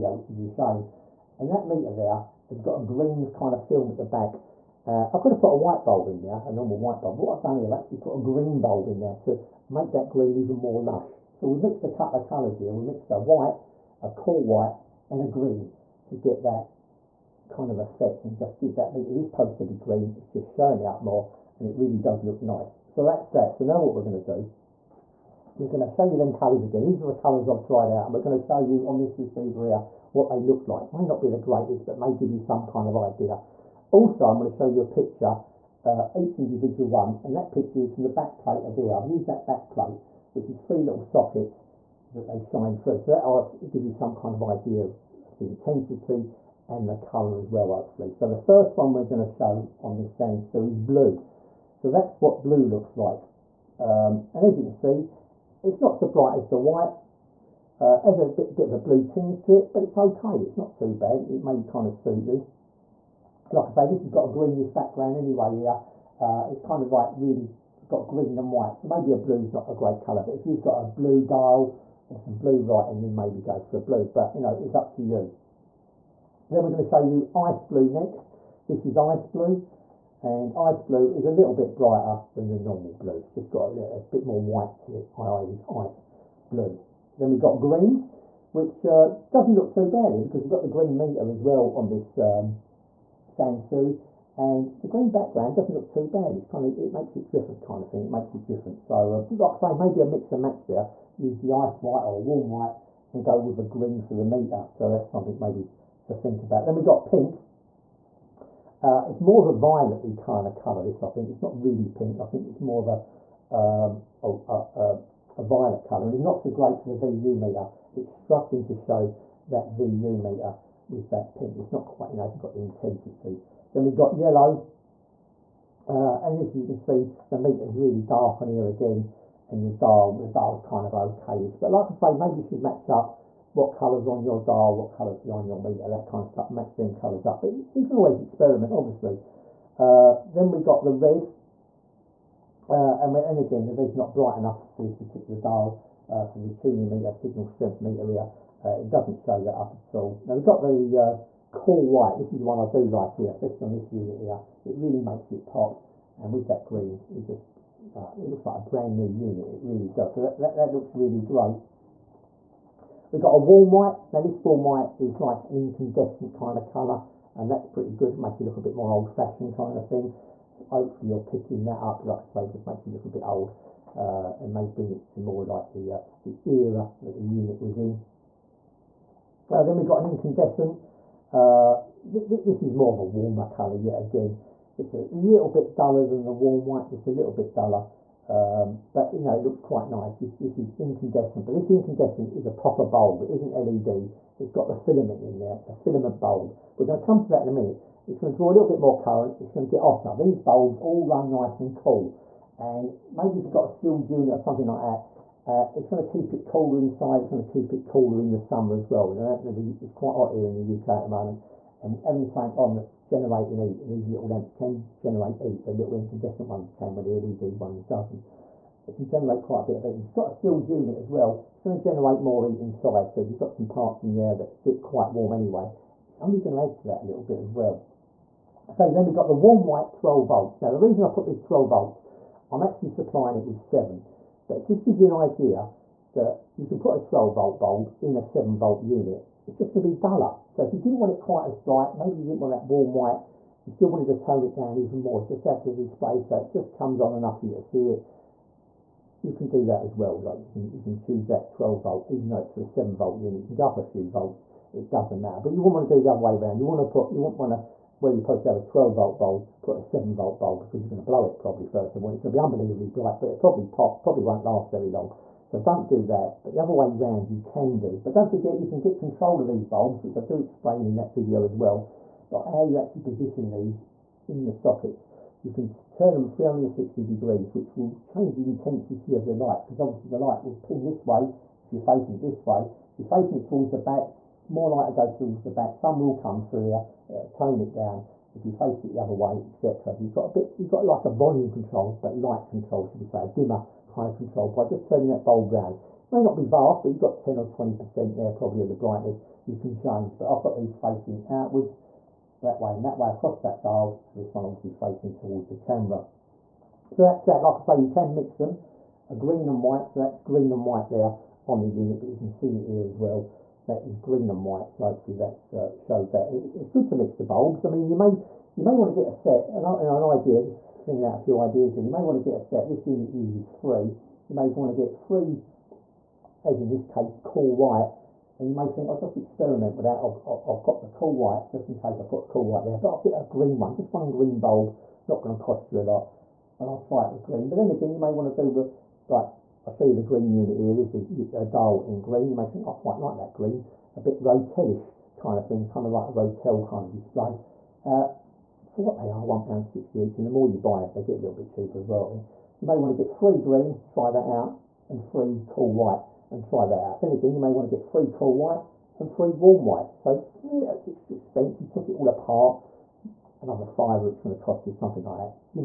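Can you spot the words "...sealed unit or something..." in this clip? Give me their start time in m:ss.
3:23.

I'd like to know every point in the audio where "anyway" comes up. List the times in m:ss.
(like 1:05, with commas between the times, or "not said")
1:05, 3:45.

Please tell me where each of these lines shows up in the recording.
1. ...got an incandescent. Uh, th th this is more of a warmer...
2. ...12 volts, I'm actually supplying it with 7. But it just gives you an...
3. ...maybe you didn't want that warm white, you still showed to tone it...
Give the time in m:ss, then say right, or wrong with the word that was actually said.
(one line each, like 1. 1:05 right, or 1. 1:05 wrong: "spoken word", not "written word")
1. 2:59 right
2. 3:51 right
3. 4:01 wrong: "wanted", not "showed".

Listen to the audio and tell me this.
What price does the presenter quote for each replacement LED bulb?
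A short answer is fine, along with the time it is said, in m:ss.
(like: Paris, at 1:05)
£1.60, at 5:49.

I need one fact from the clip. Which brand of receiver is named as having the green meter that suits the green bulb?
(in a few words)
Sansui.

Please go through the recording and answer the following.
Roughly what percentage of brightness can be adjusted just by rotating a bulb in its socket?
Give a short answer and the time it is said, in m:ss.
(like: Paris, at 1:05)
10 or 20%, at 4:57.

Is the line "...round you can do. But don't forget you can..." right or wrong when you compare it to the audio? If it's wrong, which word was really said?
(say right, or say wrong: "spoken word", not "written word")
right.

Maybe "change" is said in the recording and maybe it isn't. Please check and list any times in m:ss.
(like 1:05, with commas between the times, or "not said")
4:38, 4:59.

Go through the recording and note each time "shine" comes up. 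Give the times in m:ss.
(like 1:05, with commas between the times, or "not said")
0:42.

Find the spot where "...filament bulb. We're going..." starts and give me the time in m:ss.
3:15.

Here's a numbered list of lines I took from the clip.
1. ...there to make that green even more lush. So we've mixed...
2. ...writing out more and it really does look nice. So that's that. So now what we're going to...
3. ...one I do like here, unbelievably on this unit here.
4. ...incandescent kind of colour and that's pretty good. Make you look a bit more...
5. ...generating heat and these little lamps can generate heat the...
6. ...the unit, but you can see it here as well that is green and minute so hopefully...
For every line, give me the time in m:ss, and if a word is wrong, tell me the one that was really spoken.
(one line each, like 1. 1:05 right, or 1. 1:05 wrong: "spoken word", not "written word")
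1. 0:09 right
2. 0:20 wrong: "showing", not "writing"
3. 2:32 wrong: "especially", not "unbelievably"
4. 2:45 right
5. 3:33 right
6. 5:11 wrong: "white", not "minute".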